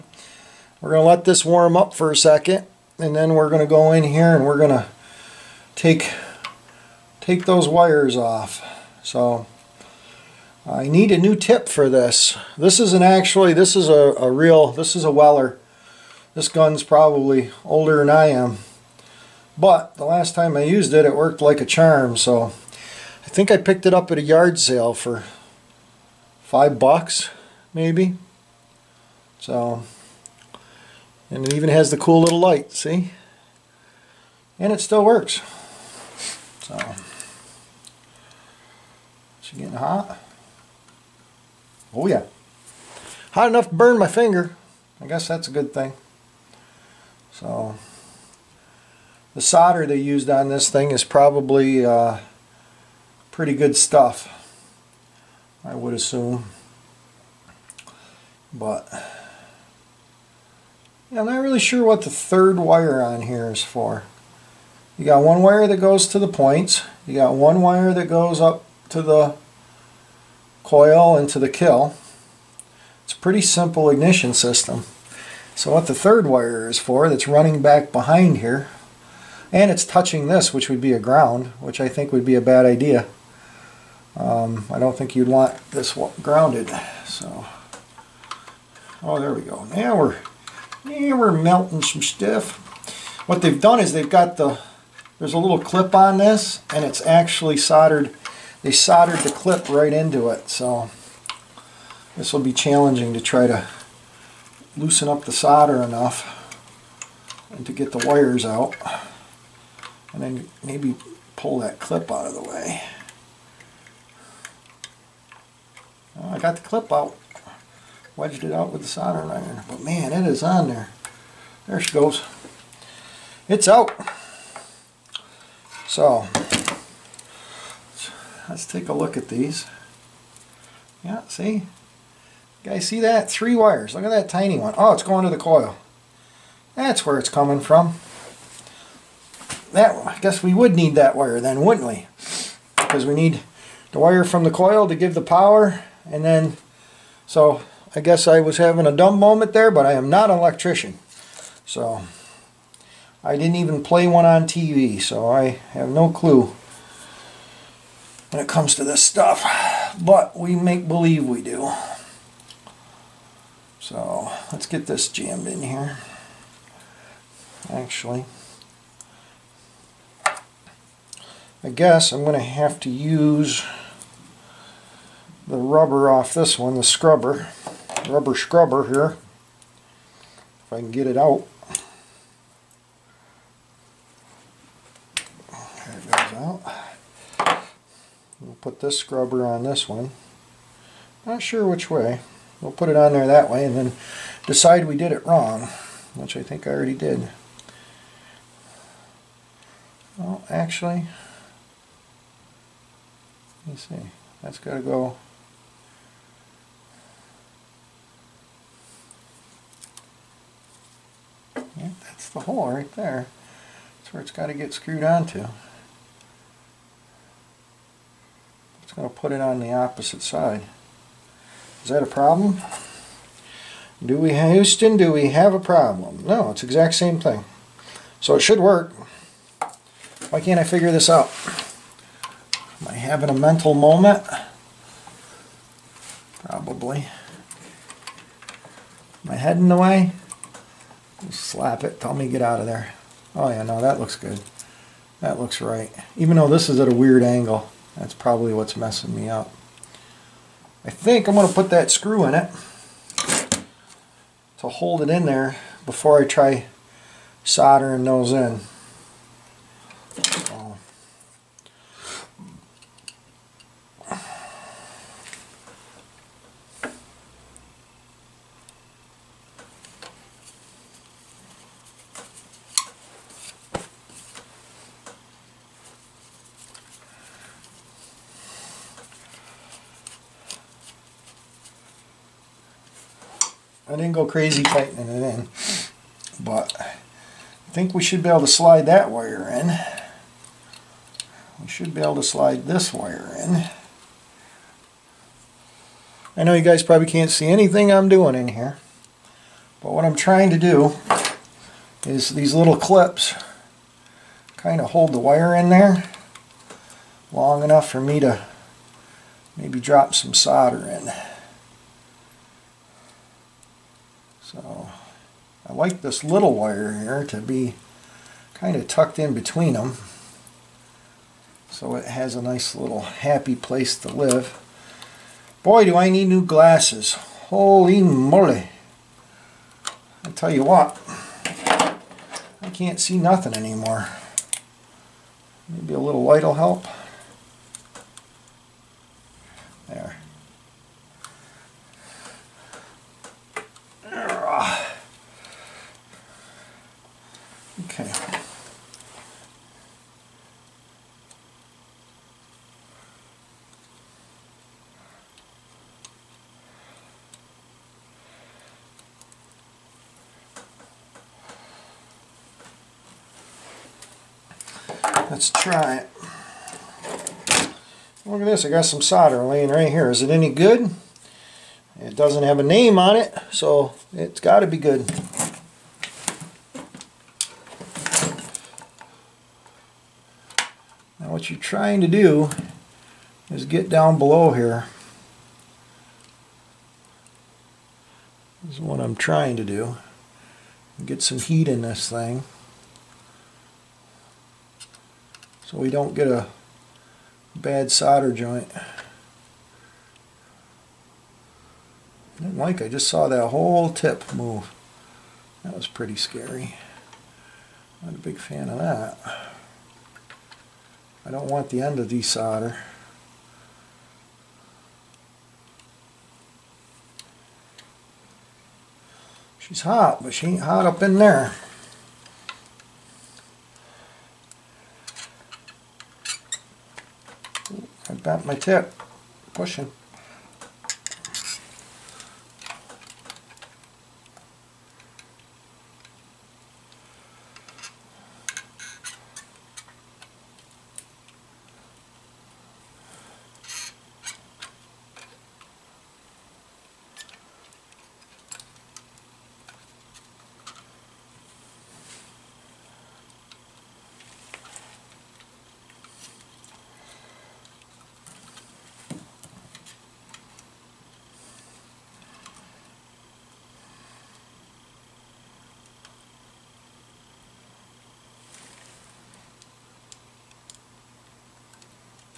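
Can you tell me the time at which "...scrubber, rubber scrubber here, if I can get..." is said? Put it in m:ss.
2:56.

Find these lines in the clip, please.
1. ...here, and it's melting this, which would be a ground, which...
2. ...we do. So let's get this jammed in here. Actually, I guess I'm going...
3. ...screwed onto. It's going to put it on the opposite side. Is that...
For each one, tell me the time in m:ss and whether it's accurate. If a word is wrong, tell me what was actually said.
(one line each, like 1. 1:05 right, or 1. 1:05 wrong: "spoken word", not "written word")
1. 1:18 wrong: "touching", not "melting"
2. 2:41 right
3. 3:34 right.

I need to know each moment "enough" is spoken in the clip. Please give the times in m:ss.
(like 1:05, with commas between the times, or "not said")
0:43, 1:45, 5:07.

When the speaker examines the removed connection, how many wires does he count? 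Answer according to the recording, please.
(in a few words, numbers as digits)
3.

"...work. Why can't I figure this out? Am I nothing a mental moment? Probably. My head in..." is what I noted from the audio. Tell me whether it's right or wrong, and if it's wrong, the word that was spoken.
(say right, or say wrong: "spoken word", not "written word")
wrong: "having", not "nothing".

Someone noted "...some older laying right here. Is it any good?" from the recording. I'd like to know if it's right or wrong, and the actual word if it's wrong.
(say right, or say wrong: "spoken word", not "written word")
wrong: "solder", not "older".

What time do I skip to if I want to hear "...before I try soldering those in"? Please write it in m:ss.
4:15.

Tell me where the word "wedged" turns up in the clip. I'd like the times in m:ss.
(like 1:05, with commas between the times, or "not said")
1:58.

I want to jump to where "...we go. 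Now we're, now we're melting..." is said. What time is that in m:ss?
1:29.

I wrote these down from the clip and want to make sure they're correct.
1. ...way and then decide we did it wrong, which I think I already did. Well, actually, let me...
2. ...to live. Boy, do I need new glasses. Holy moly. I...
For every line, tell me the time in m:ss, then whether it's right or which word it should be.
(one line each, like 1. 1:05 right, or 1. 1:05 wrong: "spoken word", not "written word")
1. 3:13 right
2. 5:23 right.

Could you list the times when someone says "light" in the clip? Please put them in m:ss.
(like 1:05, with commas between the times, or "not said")
0:32, 5:36.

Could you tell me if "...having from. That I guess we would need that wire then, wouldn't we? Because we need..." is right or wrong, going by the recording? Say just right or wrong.
wrong.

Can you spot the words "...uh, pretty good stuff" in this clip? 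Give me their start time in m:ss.
0:51.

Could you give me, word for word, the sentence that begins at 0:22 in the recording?
So I think I picked it up at a yard sale for five bucks, maybe.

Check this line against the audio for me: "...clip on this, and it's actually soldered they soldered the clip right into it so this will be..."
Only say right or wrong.
right.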